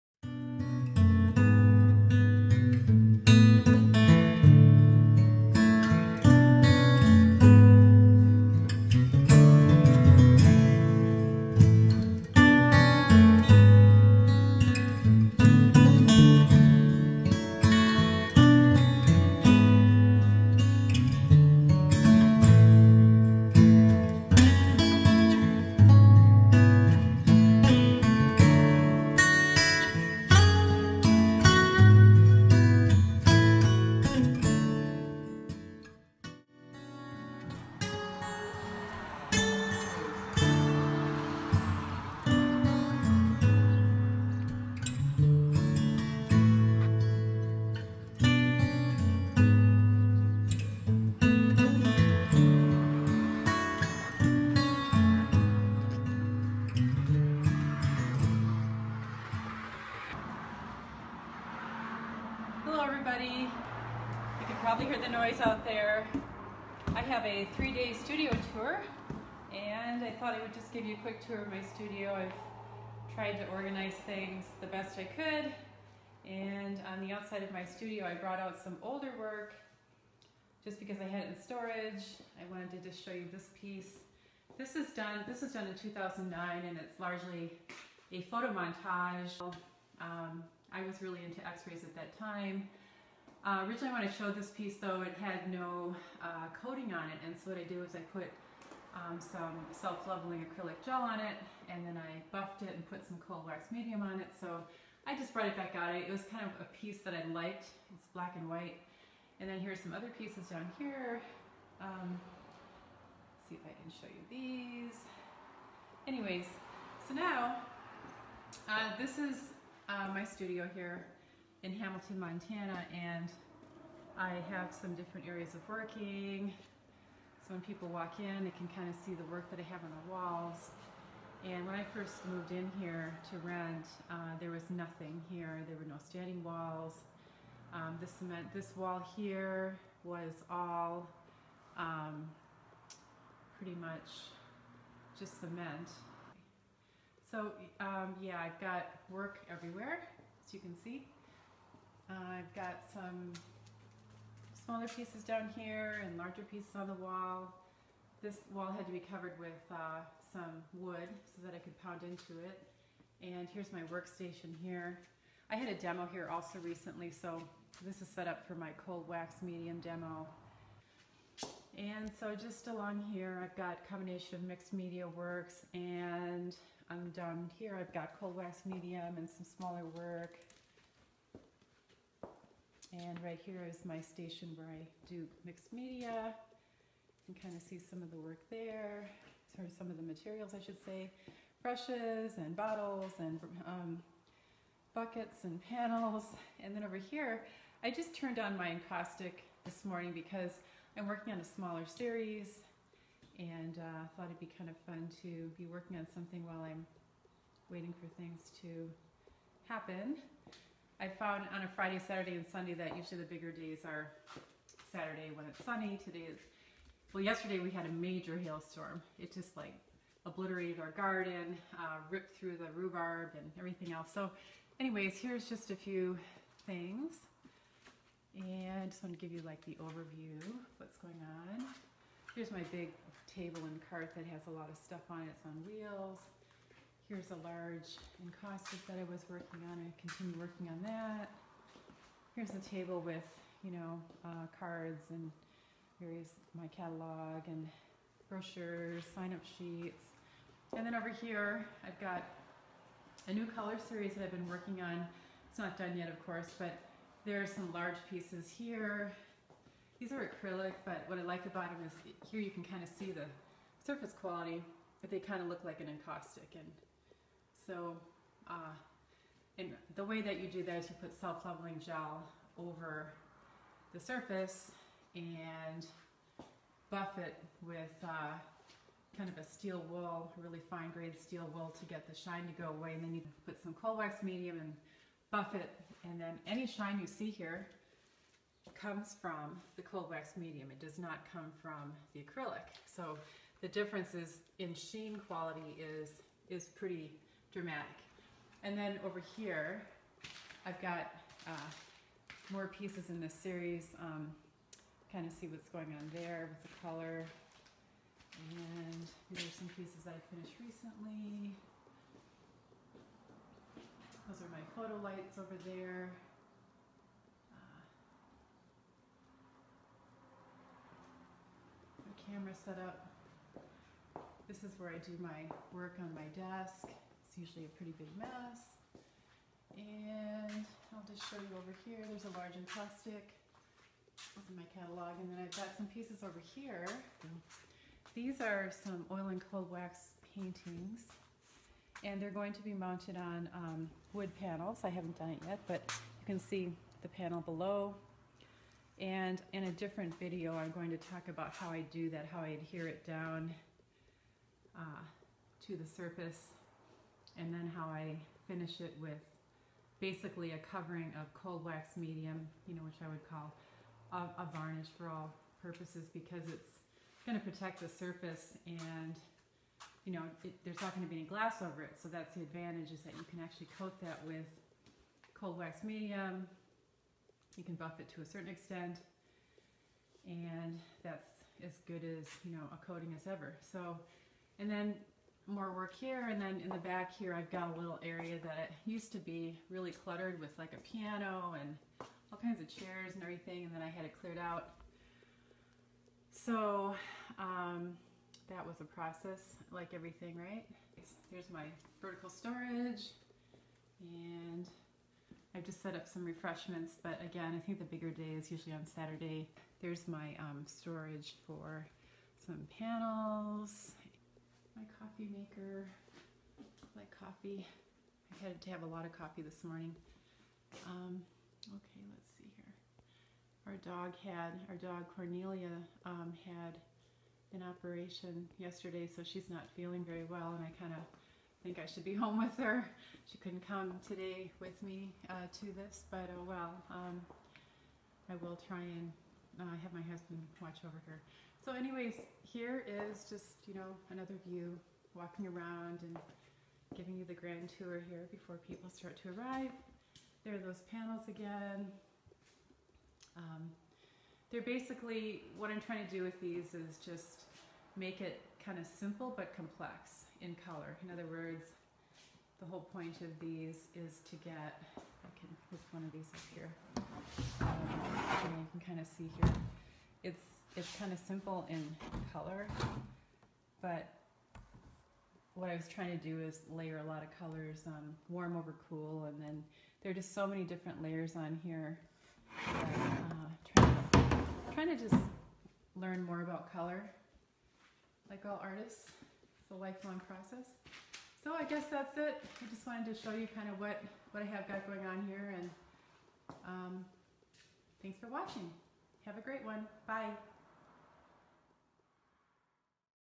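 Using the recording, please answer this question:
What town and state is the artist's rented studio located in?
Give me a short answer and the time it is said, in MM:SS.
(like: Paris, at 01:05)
Hamilton, Montana, at 02:01.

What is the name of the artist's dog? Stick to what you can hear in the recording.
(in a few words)
Cornelia.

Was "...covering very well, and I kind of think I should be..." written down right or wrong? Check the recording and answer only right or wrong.
wrong.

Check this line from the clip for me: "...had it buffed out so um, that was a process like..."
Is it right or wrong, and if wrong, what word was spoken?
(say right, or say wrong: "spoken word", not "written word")
wrong: "cleared", not "buffed".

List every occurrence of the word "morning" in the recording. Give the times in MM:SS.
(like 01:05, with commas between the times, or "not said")
03:19, 06:59.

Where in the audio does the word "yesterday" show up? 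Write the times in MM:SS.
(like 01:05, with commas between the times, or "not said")
03:37, 07:08.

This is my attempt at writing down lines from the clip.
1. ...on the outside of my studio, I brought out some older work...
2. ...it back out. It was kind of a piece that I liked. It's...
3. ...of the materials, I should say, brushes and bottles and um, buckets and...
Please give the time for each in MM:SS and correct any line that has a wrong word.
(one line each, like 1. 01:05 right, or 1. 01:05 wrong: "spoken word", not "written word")
1. 01:16 right
2. 01:45 right
3. 03:09 right.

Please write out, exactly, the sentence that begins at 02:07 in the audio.
So when people walk in, they can kind of see the work that I have on the walls.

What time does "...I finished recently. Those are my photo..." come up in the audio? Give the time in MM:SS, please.
05:10.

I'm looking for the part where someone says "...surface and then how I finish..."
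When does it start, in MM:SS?
05:55.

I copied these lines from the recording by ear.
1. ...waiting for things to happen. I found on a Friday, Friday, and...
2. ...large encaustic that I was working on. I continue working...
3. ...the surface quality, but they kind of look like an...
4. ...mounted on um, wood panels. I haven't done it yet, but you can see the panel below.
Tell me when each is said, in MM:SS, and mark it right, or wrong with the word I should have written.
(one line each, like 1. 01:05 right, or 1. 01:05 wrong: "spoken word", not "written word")
1. 03:27 wrong: "Saturday", not "Friday"
2. 03:57 right
3. 04:23 right
4. 05:42 right.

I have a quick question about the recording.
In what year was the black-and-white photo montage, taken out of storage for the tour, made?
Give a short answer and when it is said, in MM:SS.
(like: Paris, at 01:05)
2009, at 01:25.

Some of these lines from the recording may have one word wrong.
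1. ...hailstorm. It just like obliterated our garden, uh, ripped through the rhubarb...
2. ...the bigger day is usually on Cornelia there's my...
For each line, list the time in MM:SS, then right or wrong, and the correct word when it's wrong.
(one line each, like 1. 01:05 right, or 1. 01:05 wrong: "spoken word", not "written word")
1. 03:38 right
2. 06:47 wrong: "Saturday", not "Cornelia".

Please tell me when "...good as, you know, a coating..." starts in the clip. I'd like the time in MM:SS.
06:21.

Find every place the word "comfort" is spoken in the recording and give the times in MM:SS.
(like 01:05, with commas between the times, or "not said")
not said.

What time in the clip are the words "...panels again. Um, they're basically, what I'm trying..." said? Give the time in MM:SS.
07:30.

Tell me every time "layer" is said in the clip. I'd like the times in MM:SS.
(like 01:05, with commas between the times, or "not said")
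07:56, 08:01.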